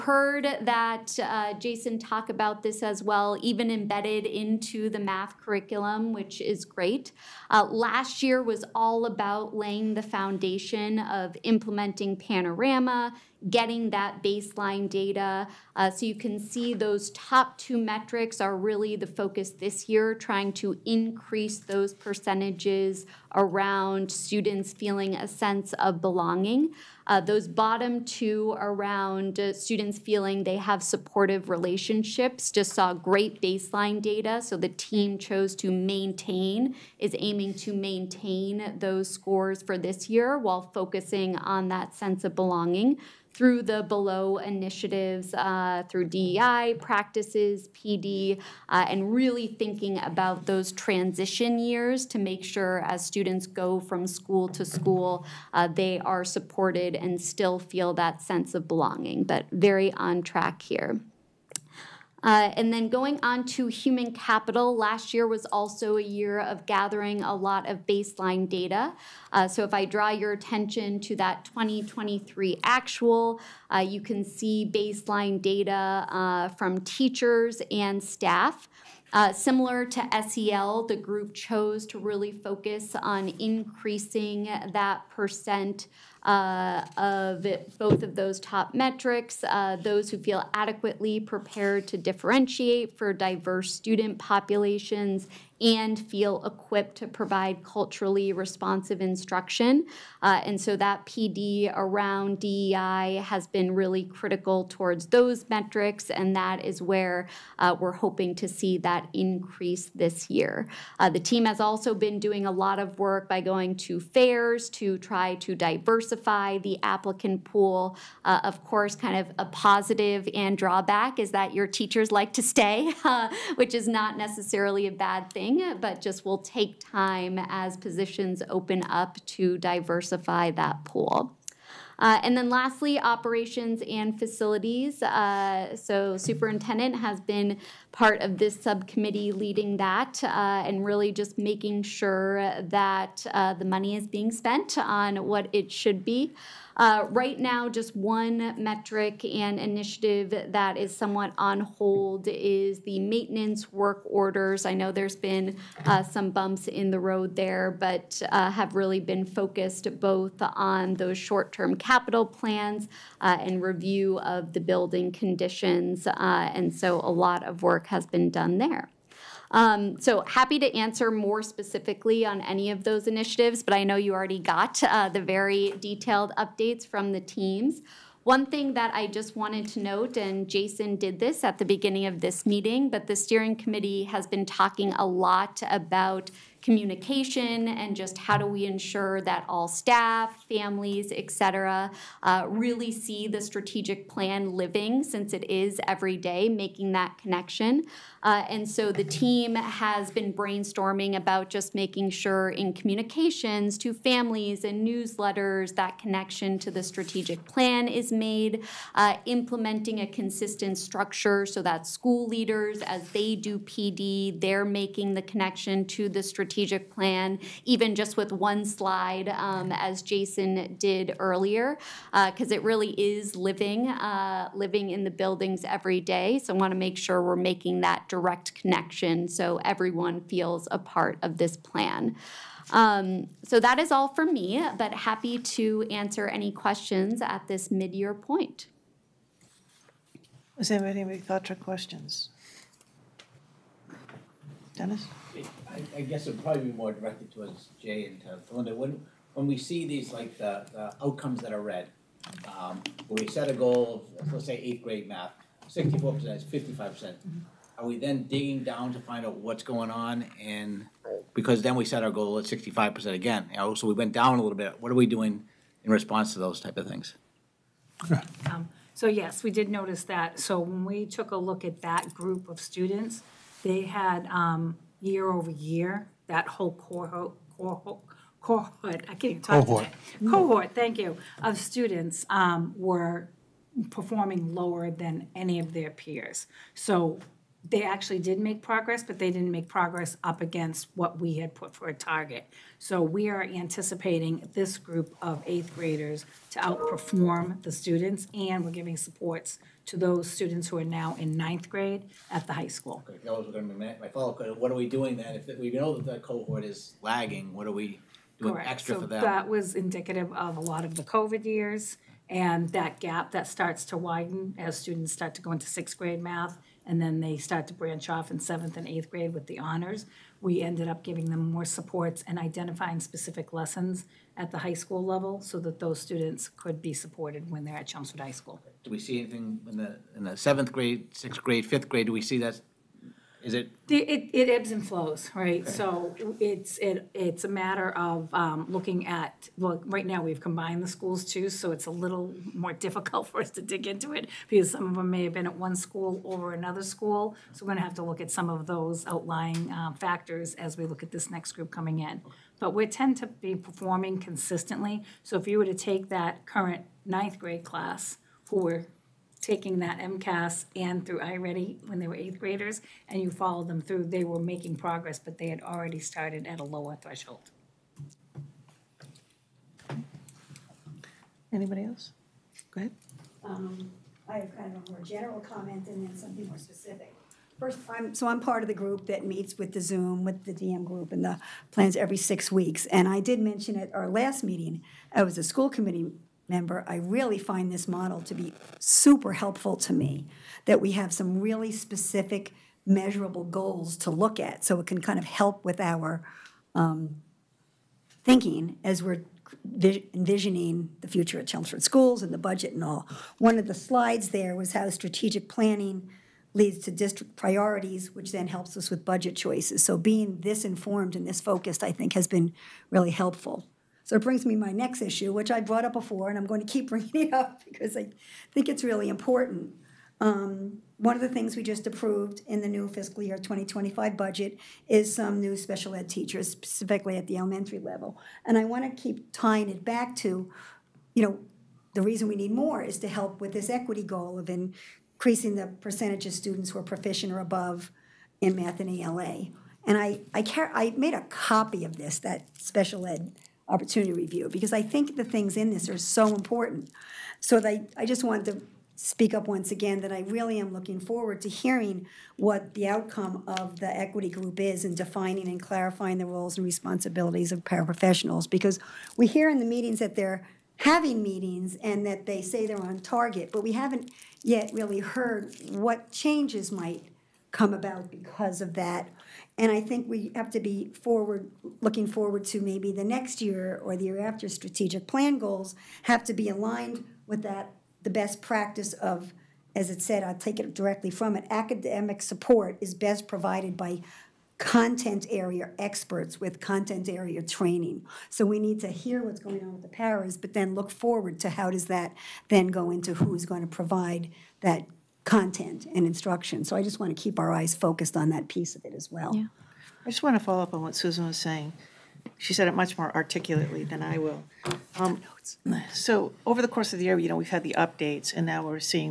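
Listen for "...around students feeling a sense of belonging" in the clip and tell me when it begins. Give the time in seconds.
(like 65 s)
23 s.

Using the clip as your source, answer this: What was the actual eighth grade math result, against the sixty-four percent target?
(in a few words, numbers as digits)
55%.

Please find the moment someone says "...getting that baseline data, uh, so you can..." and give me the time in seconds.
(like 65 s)
13 s.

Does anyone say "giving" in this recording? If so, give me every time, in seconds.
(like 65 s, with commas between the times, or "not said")
298 s, 321 s.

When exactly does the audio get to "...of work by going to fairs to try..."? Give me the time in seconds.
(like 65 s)
112 s.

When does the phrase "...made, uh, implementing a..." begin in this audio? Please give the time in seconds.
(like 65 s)
208 s.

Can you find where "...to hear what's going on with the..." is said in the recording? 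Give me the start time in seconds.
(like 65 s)
488 s.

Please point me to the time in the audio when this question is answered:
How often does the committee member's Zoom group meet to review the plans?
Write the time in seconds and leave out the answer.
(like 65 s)
381 s.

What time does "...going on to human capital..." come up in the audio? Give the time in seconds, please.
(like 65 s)
62 s.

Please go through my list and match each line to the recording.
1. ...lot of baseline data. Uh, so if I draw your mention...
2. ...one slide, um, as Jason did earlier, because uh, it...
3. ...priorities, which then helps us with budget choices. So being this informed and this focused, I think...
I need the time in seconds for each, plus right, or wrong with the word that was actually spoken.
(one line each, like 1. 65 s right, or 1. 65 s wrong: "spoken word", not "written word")
1. 67 s wrong: "attention", not "mention"
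2. 218 s right
3. 407 s right.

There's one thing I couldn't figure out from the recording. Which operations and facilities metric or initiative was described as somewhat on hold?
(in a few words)
Maintenance work orders.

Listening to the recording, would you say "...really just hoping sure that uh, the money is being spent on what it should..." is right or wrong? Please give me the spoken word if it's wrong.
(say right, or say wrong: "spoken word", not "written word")
wrong: "making", not "hoping".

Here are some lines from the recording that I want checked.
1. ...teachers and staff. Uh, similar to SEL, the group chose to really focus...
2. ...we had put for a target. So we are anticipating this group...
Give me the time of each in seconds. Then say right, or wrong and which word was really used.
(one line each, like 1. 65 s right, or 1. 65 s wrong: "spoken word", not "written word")
1. 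76 s right
2. 291 s right.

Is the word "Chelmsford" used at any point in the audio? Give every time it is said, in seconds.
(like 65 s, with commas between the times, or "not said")
327 s, 401 s.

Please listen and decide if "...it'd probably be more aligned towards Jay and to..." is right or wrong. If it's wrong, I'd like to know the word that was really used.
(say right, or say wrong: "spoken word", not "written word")
wrong: "directed", not "aligned".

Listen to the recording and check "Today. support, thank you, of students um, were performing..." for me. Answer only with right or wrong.
wrong.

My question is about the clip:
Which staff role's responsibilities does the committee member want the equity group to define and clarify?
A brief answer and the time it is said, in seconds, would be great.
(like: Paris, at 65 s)
Paraprofessionals, at 457 s.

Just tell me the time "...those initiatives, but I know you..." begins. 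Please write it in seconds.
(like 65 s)
172 s.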